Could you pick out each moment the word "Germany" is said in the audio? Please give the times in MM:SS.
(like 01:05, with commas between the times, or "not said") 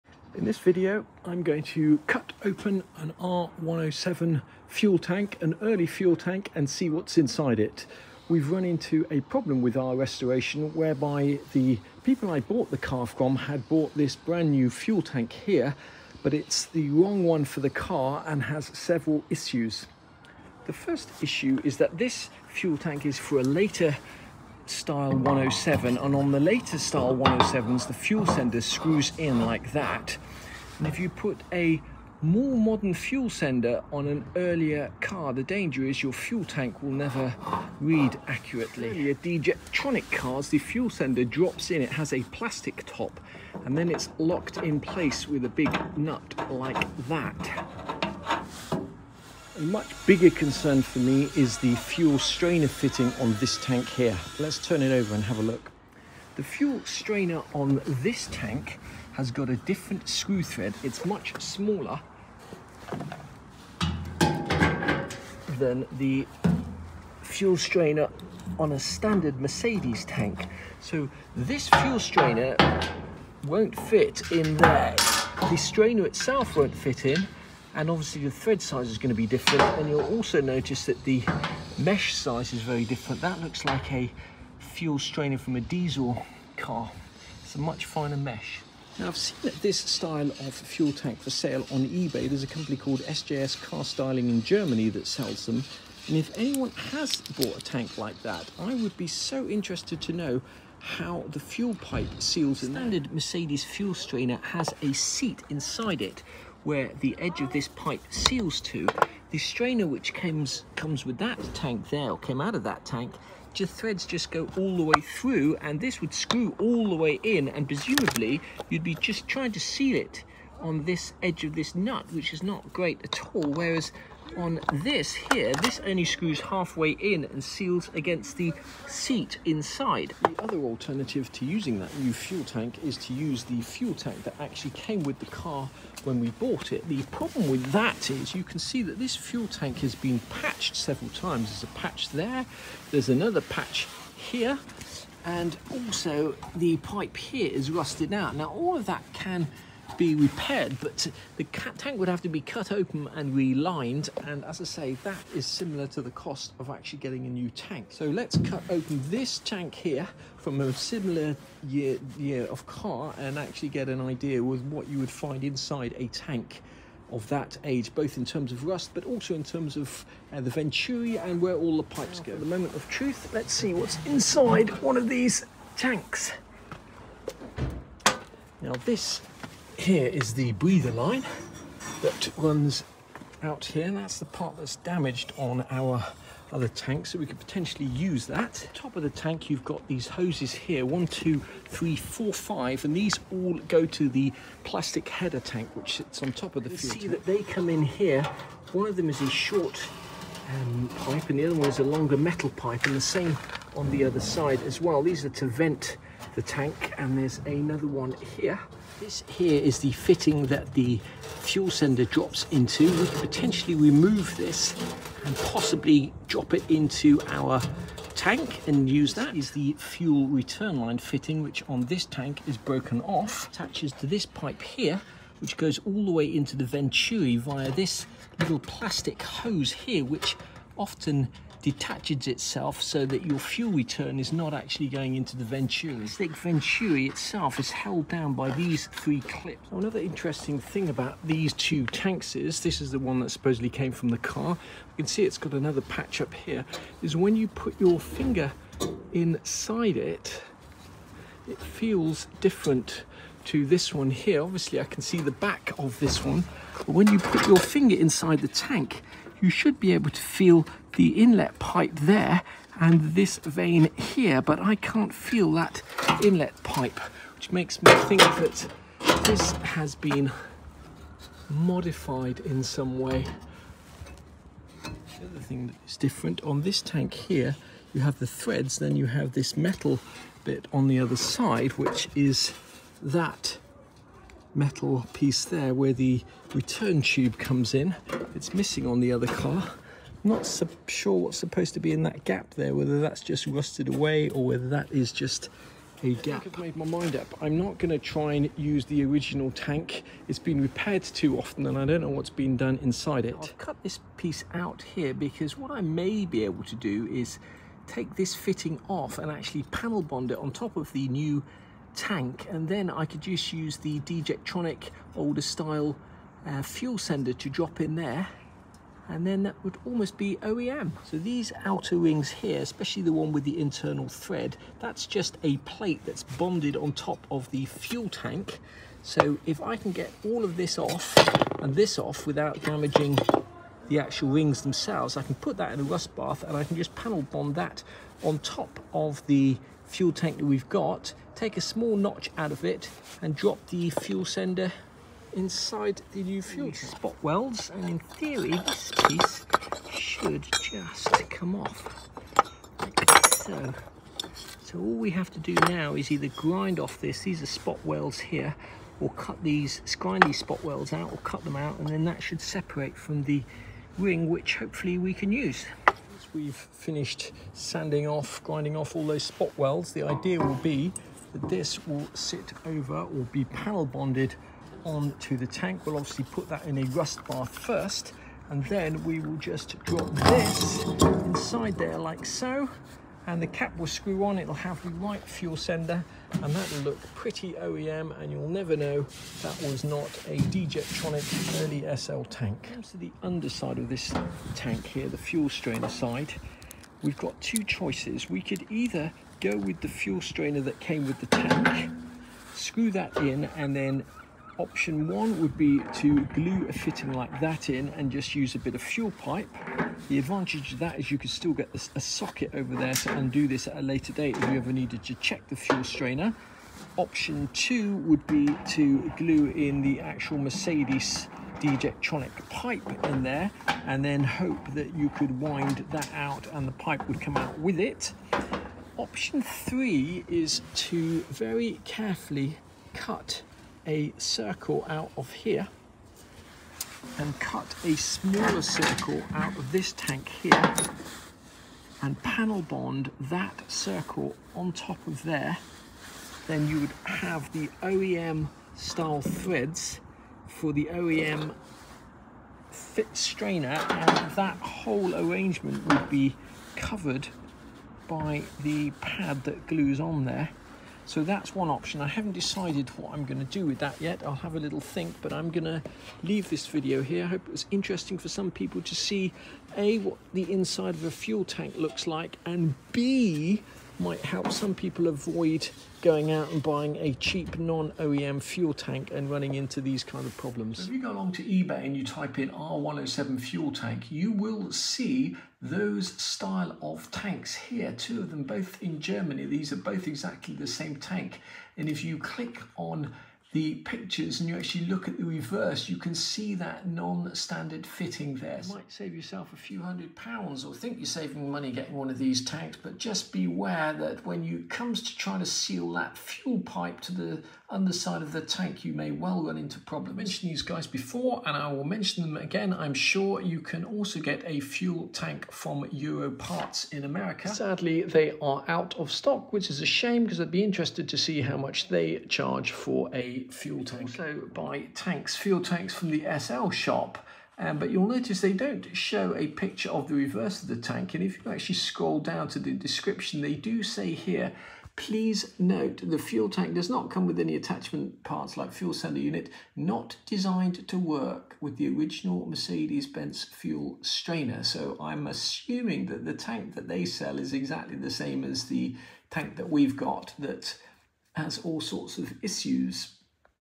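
01:34, 08:08.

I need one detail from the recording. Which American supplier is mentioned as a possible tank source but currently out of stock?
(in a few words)
Euro Parts.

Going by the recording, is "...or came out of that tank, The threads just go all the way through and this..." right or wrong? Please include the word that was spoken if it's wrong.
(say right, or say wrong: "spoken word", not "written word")
right.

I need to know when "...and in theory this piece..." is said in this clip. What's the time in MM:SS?
05:47.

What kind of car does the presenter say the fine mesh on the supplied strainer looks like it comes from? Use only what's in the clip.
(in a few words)
diesel car.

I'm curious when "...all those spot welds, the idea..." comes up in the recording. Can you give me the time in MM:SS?
06:08.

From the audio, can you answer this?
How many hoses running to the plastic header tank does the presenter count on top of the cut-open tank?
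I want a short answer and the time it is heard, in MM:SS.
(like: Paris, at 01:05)
5, at 03:12.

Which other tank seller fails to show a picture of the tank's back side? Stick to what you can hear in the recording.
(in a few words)
the SL shop.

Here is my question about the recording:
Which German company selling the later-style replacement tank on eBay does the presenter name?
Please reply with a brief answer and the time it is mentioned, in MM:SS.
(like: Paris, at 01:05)
SJS car styling, at 01:33.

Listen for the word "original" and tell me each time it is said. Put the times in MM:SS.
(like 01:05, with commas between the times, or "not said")
04:59, 09:01.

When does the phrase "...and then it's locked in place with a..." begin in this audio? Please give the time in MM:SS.
00:43.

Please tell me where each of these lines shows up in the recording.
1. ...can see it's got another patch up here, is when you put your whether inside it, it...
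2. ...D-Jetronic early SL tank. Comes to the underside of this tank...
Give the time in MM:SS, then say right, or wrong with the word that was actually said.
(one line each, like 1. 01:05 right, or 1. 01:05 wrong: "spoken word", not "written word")
1. 04:05 wrong: "finger", not "whether"
2. 06:30 right.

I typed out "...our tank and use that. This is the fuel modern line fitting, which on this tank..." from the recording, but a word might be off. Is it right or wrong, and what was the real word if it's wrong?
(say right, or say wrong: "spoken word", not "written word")
wrong: "return", not "modern".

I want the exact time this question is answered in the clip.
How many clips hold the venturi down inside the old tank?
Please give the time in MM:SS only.
03:58.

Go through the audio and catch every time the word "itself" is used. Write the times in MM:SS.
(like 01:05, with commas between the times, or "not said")
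01:16, 03:52, 03:57.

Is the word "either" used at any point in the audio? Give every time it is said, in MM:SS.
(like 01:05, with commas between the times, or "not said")
05:56, 06:38.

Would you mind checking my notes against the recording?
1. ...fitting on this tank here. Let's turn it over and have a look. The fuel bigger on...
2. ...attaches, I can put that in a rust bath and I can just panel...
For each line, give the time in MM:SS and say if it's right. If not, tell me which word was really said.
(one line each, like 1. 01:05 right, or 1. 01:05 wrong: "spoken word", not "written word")
1. 00:52 wrong: "strainer", not "bigger"
2. 05:34 wrong: "themselves", not "attaches".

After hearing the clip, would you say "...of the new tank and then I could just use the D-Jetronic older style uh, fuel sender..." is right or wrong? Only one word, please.
right.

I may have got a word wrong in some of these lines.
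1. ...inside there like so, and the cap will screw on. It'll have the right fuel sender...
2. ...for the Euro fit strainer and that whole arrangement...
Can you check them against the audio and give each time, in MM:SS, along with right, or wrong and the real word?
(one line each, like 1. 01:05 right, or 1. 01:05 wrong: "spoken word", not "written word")
1. 06:20 right
2. 07:30 wrong: "OEM", not "Euro".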